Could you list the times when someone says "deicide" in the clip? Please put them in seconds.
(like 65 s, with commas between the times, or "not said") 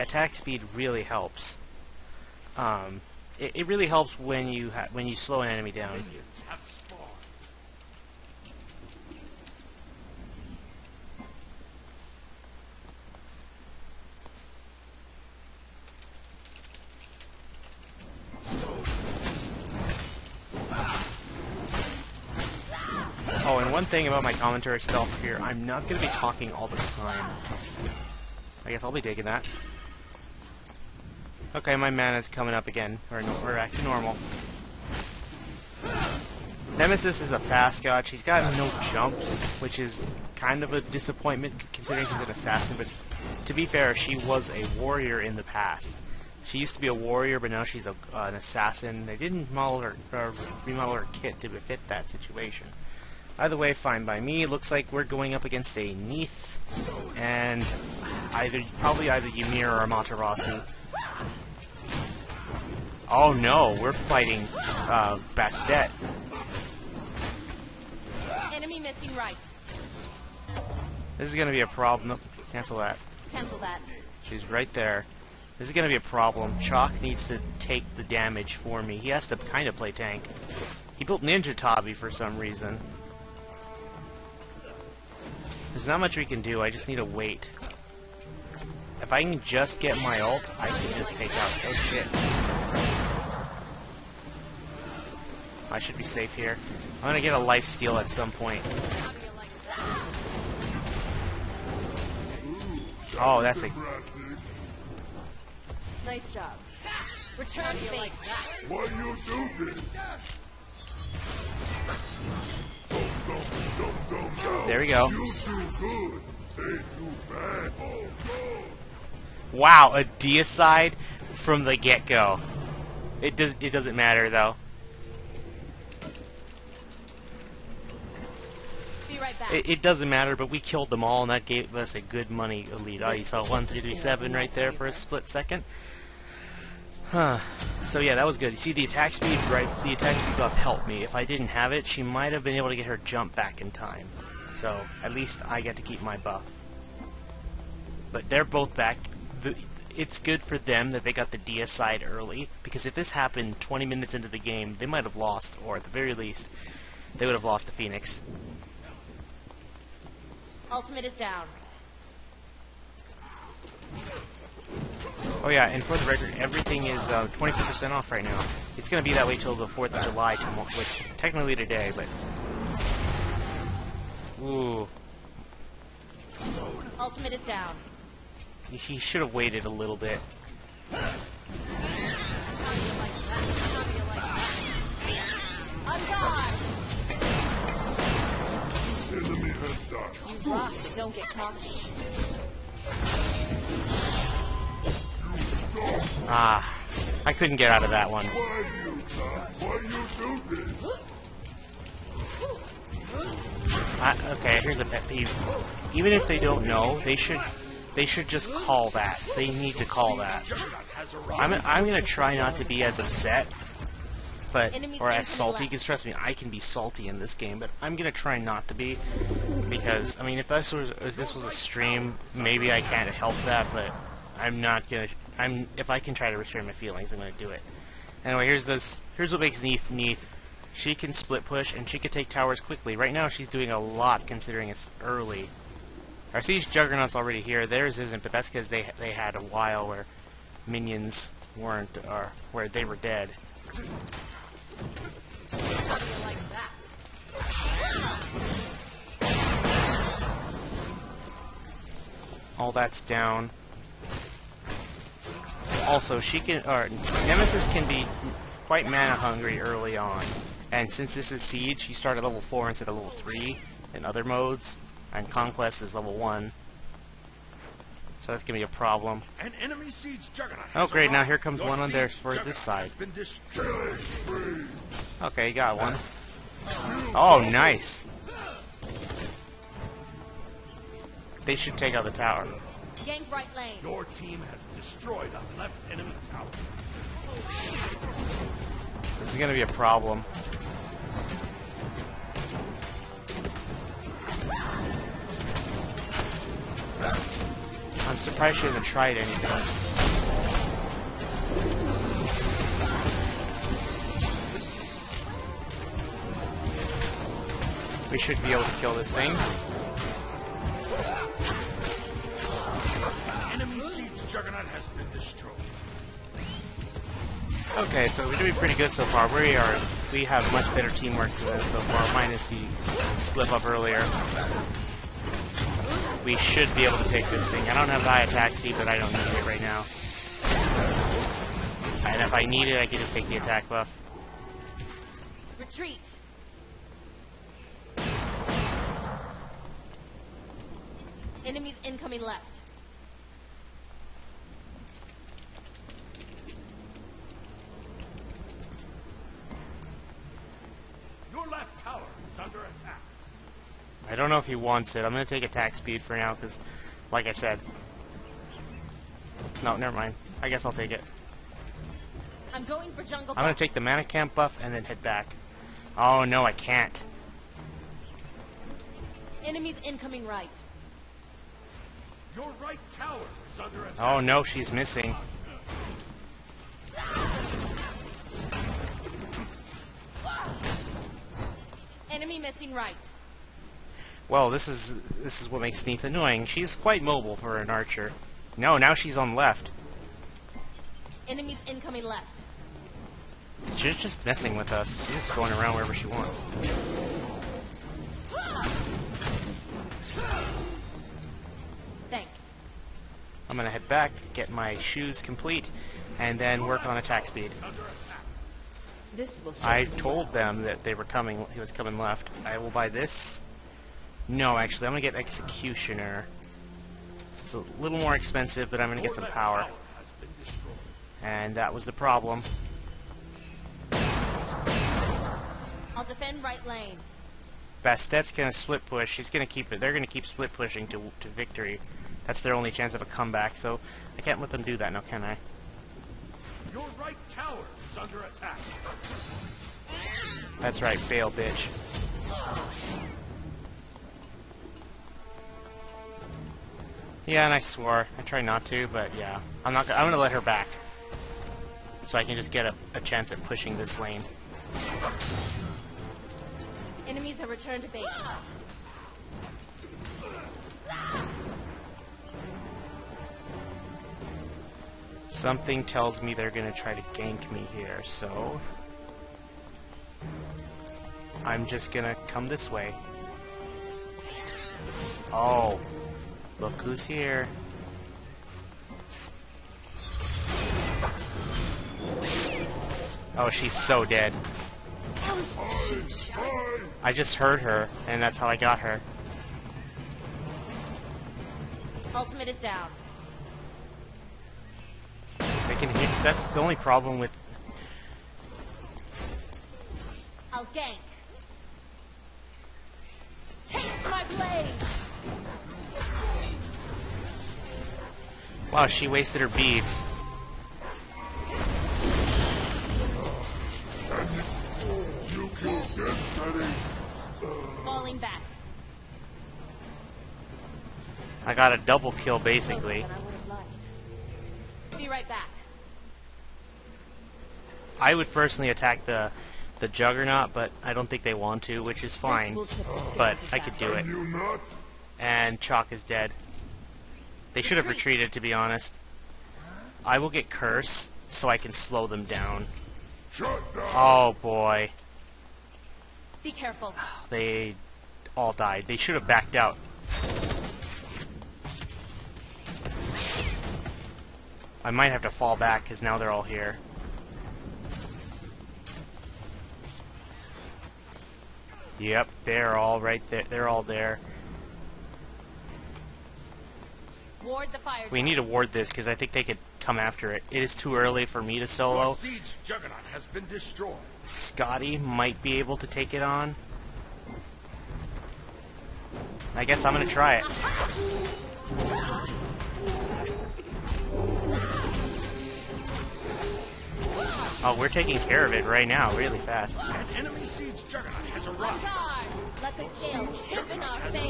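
120 s, 151 s.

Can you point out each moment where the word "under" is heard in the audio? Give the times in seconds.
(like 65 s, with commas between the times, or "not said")
352 s, 373 s, 438 s.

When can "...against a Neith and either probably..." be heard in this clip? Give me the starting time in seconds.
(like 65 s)
55 s.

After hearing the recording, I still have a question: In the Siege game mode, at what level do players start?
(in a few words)
Level 4.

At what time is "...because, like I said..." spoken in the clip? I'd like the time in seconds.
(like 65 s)
356 s.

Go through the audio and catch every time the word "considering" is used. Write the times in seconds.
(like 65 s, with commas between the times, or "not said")
41 s, 234 s.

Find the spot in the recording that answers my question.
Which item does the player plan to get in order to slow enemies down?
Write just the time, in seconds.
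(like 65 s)
540 s.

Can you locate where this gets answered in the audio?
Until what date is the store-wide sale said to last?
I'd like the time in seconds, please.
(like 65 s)
169 s.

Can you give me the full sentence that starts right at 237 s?
Theirs isn't, but that's because they they had a while where minions weren't, or uh, where they were dead.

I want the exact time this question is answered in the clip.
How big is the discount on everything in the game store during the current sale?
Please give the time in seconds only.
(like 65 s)
167 s.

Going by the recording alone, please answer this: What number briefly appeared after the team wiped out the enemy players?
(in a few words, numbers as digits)
1337.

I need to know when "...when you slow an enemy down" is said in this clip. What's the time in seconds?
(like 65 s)
4 s.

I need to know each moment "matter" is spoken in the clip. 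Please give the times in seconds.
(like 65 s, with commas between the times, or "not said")
123 s, 130 s.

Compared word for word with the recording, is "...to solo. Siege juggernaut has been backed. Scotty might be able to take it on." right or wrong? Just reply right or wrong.
wrong.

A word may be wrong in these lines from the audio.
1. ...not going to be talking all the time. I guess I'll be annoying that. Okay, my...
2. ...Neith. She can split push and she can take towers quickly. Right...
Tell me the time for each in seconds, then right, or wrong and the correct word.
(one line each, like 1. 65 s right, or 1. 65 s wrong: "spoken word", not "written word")
1. 25 s wrong: "taking", not "annoying"
2. 229 s right.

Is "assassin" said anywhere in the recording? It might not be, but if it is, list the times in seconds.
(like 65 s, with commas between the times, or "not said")
42 s, 48 s.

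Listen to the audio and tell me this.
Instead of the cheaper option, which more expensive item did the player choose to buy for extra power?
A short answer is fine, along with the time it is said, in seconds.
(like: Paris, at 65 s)
Executioner, at 415 s.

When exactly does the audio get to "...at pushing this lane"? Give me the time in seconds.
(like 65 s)
453 s.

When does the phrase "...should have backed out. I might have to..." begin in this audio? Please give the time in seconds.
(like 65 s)
548 s.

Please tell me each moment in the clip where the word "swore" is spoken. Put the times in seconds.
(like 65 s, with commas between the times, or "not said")
447 s.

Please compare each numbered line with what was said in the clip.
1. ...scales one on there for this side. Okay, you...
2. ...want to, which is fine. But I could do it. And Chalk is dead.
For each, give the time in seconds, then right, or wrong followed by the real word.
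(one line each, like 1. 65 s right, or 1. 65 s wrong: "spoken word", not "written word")
1. 271 s wrong: "comes", not "scales"
2. 531 s right.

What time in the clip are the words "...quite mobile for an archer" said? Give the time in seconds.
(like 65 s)
386 s.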